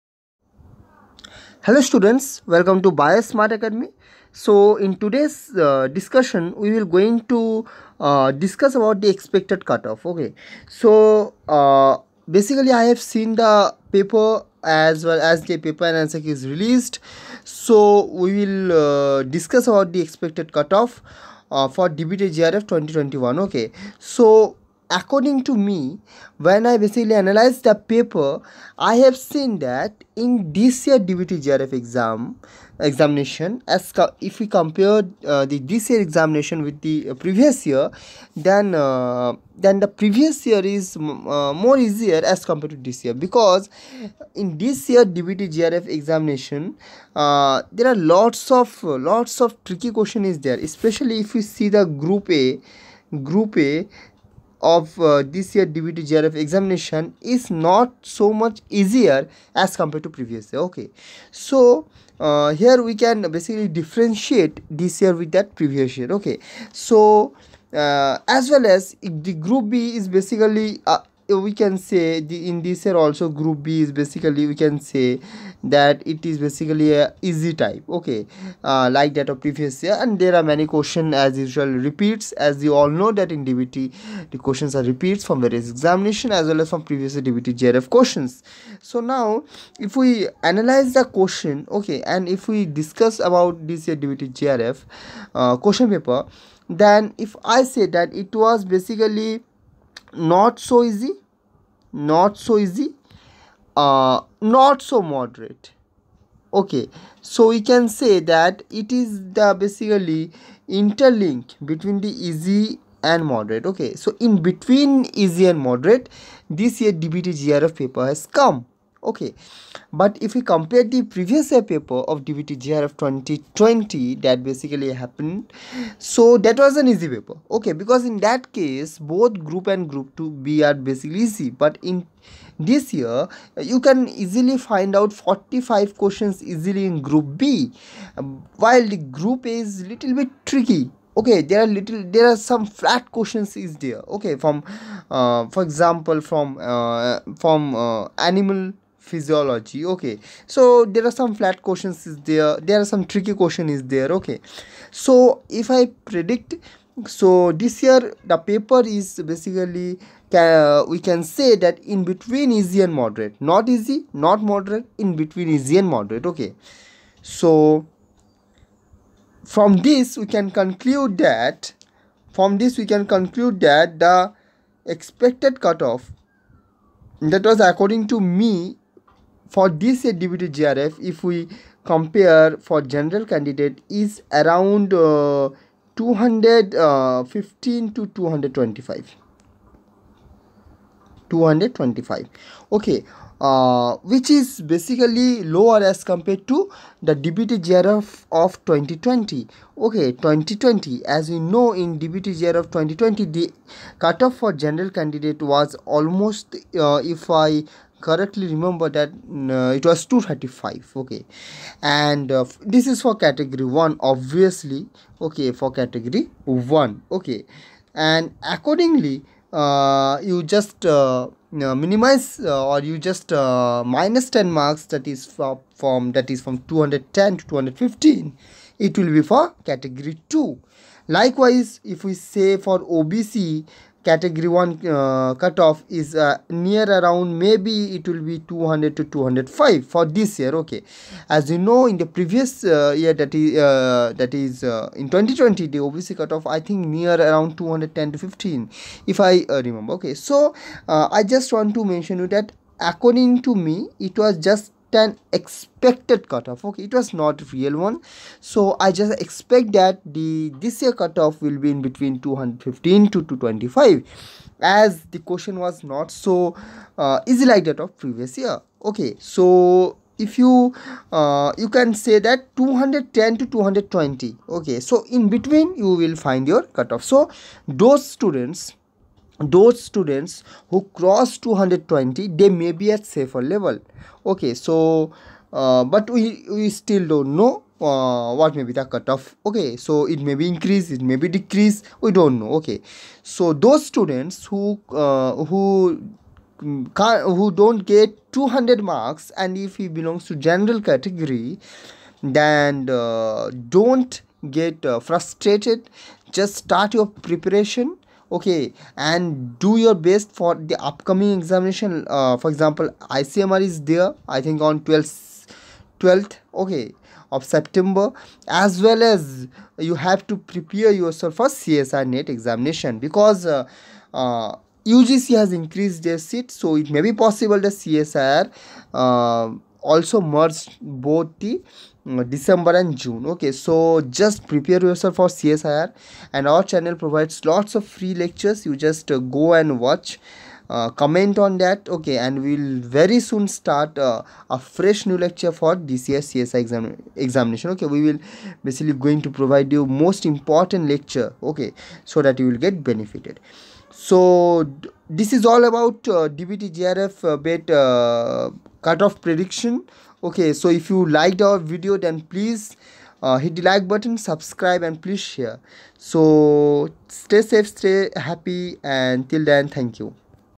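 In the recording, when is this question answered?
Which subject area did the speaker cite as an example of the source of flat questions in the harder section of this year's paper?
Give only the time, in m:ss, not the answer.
2:28.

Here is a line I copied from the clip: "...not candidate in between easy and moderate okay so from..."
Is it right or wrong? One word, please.
wrong.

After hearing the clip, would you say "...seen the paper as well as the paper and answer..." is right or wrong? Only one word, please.
right.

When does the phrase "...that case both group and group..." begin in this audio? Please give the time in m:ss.
2:08.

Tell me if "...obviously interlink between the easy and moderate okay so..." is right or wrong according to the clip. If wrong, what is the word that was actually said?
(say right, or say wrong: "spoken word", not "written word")
wrong: "basically", not "obviously".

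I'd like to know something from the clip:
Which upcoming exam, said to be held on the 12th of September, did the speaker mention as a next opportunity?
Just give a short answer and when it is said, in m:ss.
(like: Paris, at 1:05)
ICMR, at 5:13.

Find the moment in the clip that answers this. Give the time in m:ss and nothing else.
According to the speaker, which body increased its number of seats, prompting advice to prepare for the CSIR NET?
5:24.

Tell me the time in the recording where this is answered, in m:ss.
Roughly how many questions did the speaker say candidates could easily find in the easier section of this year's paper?
2:15.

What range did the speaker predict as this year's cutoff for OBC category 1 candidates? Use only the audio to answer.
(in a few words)
200 to 205.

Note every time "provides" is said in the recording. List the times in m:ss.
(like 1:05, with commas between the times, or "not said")
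5:36, 5:49.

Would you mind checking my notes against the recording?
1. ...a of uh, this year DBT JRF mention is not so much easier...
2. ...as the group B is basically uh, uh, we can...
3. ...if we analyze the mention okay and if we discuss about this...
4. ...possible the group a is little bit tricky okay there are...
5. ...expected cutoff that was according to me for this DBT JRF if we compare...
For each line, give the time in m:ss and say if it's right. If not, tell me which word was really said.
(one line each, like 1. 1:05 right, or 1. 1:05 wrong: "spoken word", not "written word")
1. 0:53 wrong: "examination", not "mention"
2. 1:08 right
3. 1:29 wrong: "question", not "mention"
4. 2:18 wrong: "while", not "possible"
5. 2:54 right.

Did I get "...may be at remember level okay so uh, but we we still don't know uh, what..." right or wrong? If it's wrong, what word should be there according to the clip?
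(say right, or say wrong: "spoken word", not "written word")
wrong: "safer", not "remember".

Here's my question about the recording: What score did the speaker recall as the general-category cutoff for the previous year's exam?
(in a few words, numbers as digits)
235.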